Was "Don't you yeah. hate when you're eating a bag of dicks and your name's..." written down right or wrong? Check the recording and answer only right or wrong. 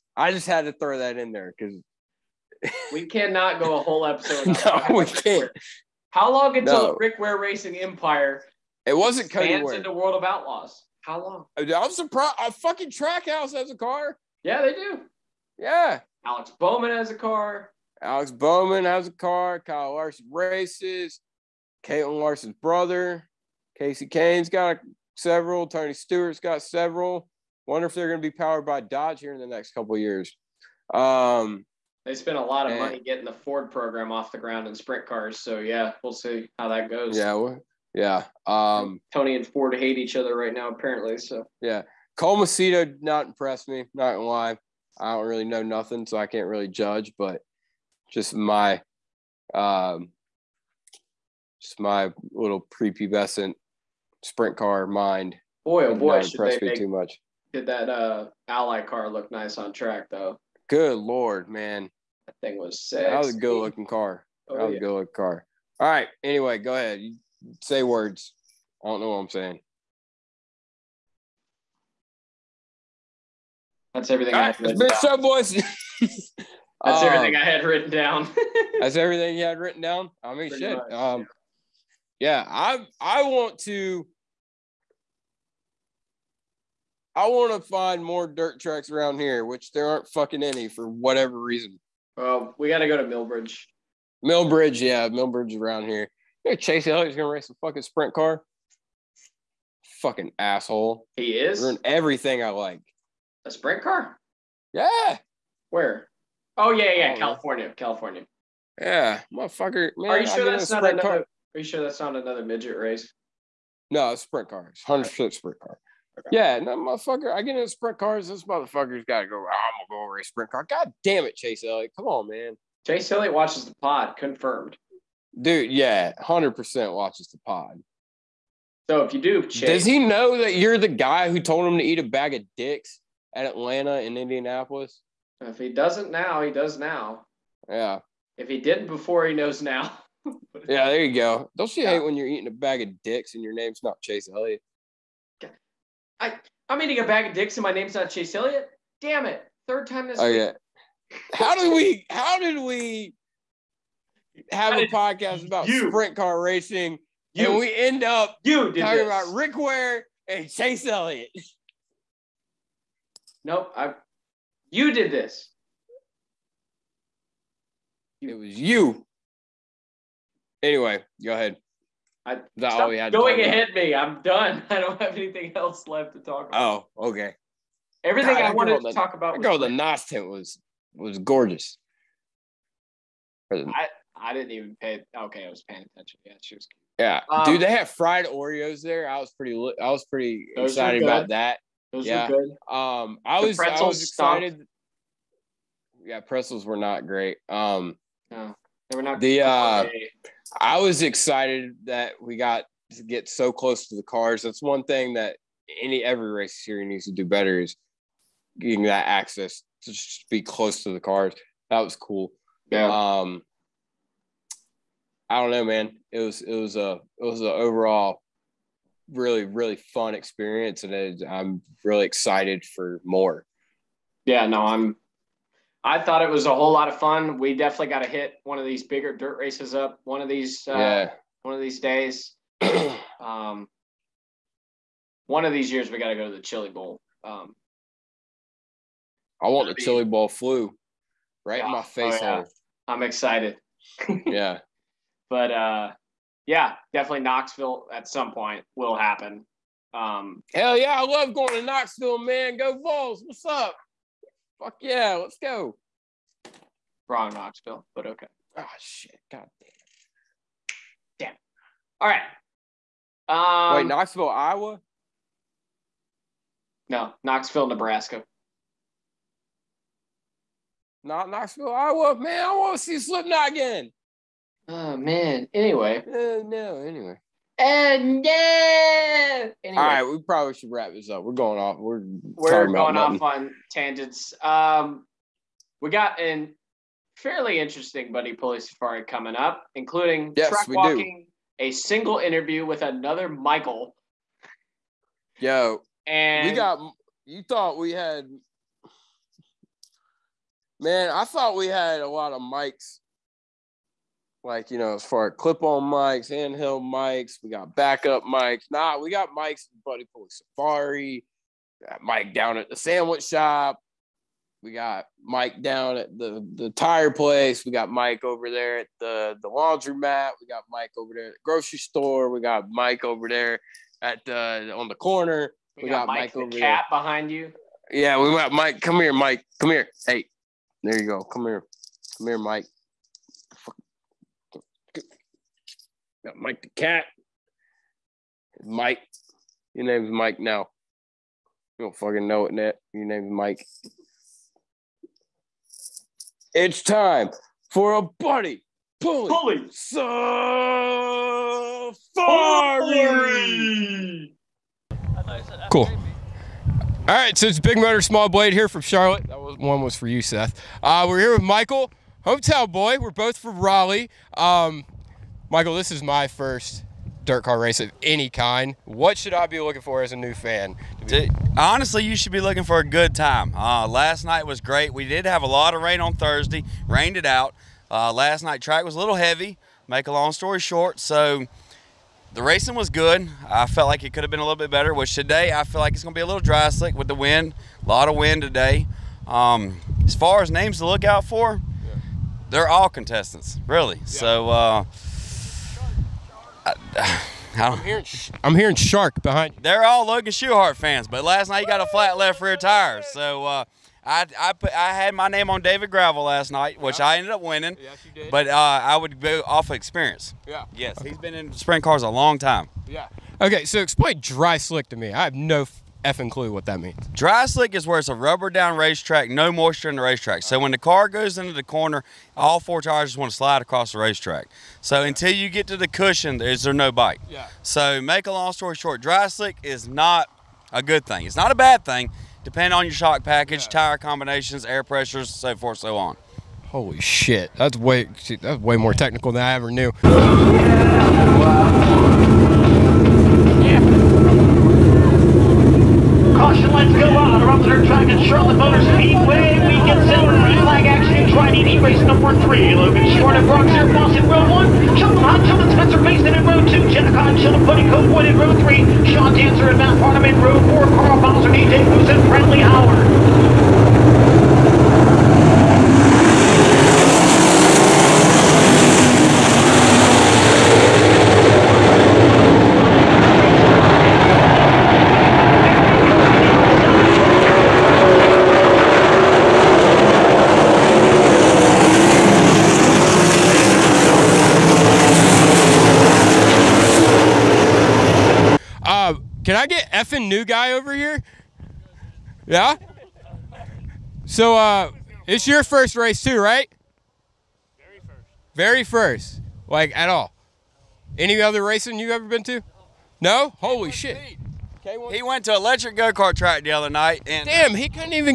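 right.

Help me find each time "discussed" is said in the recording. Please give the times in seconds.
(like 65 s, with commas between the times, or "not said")
not said.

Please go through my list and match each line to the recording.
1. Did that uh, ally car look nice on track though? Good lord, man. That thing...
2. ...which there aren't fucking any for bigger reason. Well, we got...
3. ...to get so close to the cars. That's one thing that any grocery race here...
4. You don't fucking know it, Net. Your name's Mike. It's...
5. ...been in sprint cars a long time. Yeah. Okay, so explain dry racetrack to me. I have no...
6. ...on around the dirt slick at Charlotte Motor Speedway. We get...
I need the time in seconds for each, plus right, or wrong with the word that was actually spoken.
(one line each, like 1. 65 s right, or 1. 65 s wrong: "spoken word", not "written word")
1. 57 s right
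2. 89 s wrong: "whatever", not "bigger"
3. 202 s wrong: "every", not "grocery"
4. 341 s right
5. 411 s wrong: "slick", not "racetrack"
6. 447 s wrong: "track", not "slick".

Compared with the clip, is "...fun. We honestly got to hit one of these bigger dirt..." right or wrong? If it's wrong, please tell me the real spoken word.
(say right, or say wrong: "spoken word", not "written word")
wrong: "definitely", not "honestly".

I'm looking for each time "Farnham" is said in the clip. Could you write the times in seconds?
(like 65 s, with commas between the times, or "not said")
459 s.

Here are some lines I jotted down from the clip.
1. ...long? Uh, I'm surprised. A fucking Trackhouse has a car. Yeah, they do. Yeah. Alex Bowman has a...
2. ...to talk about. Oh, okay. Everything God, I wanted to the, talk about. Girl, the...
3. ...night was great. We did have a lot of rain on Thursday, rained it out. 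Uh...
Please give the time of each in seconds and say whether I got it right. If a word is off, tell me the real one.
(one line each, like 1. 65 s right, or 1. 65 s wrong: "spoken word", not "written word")
1. 11 s right
2. 176 s right
3. 374 s right.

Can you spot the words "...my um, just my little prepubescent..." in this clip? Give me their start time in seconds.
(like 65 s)
48 s.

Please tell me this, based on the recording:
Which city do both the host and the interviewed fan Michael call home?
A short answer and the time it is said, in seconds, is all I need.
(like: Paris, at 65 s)
Raleigh, at 363 s.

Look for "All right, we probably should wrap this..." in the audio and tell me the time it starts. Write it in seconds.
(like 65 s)
279 s.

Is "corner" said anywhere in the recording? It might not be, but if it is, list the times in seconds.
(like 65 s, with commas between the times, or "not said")
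324 s, 421 s.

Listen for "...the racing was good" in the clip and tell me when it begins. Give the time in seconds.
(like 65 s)
382 s.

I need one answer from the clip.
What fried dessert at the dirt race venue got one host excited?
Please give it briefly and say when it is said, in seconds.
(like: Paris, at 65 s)
Fried Oreos, at 187 s.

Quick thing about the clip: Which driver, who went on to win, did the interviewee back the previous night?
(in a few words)
David Gravel.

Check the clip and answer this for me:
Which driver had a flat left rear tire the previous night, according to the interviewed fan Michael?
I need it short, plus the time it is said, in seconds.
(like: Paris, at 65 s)
Logan Schuchart, at 400 s.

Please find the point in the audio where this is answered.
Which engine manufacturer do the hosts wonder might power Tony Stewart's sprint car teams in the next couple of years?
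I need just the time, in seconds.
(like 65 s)
28 s.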